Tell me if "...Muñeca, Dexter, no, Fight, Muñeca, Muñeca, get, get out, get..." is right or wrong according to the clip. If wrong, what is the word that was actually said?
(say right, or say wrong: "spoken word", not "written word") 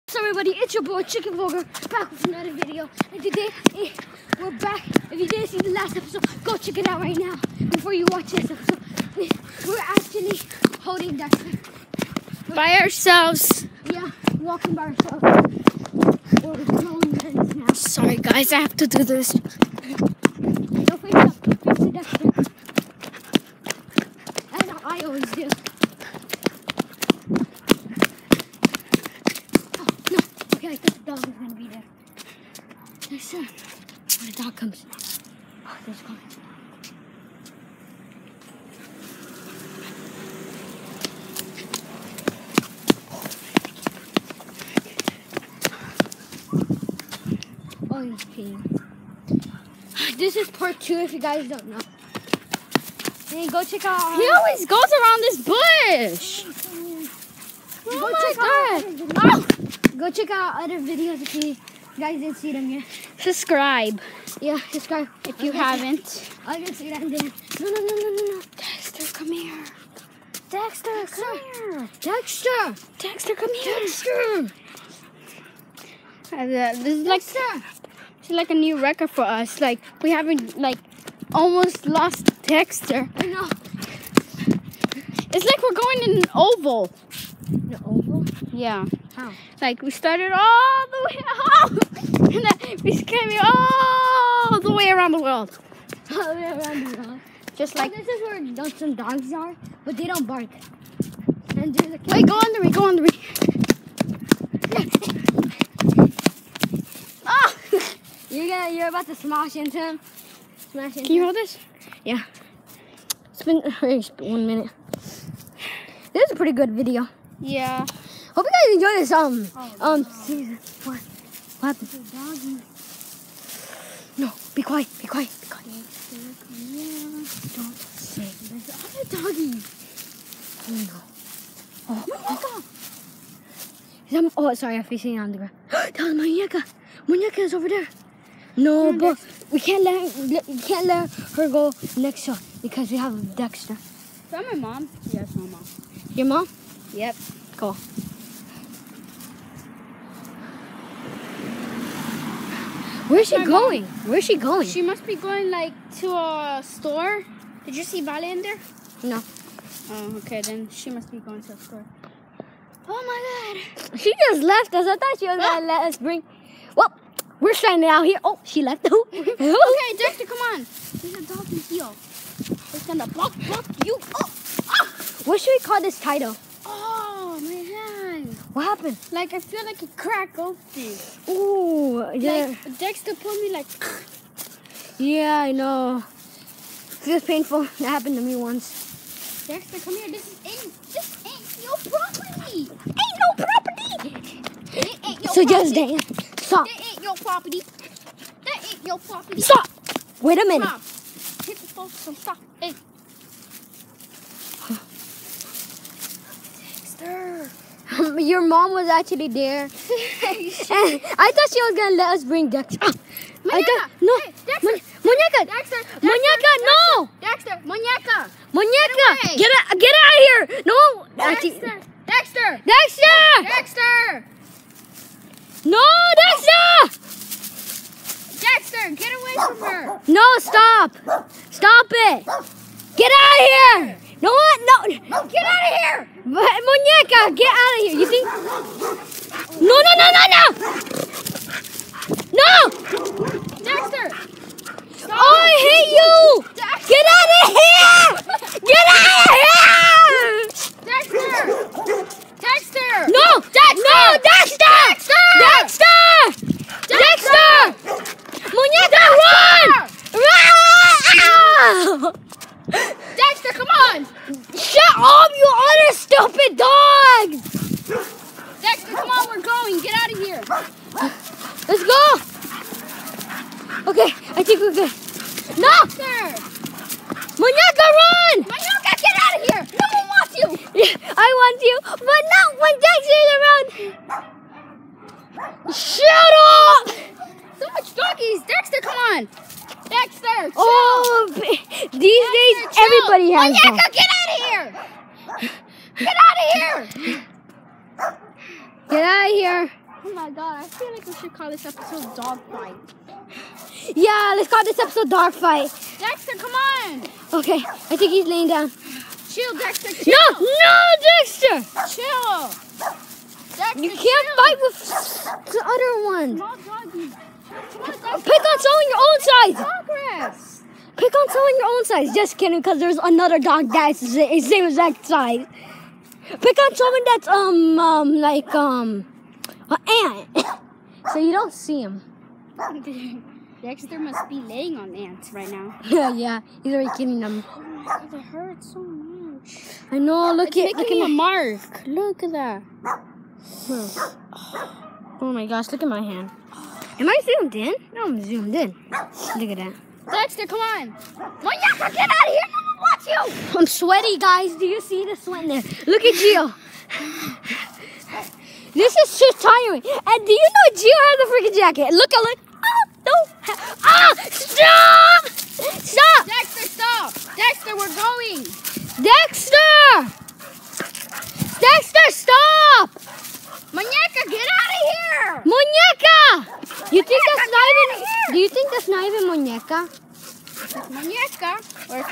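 wrong: "Dexter", not "Fight".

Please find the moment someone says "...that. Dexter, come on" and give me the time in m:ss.
5:49.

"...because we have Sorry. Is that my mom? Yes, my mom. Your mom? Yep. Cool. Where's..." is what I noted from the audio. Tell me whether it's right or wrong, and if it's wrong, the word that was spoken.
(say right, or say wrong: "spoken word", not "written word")
wrong: "Dexter", not "Sorry".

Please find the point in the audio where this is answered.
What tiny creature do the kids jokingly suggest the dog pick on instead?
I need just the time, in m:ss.
5:29.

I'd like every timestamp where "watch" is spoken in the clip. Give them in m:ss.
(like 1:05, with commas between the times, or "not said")
0:08, 5:52.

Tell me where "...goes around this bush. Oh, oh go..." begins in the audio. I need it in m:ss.
0:54.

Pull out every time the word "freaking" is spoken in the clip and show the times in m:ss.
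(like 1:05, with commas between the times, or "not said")
6:01.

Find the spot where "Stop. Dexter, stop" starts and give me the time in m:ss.
6:05.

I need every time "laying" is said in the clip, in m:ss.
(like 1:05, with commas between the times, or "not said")
5:08, 5:34.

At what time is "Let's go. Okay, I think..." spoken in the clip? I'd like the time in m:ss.
4:31.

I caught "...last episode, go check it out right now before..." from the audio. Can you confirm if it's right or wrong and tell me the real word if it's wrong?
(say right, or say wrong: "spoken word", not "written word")
right.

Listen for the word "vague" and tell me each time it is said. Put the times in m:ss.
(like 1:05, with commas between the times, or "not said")
not said.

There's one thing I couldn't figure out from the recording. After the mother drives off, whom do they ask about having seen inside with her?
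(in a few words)
Vale.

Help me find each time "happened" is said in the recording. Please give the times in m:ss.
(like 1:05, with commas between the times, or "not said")
2:58, 3:07.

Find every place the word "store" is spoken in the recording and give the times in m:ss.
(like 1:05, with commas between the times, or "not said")
2:36, 2:41.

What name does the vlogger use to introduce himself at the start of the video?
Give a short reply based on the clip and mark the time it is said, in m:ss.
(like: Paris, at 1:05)
Chicken Vlogger, at 0:01.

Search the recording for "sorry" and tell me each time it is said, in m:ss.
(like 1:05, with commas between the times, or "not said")
0:17, 2:14.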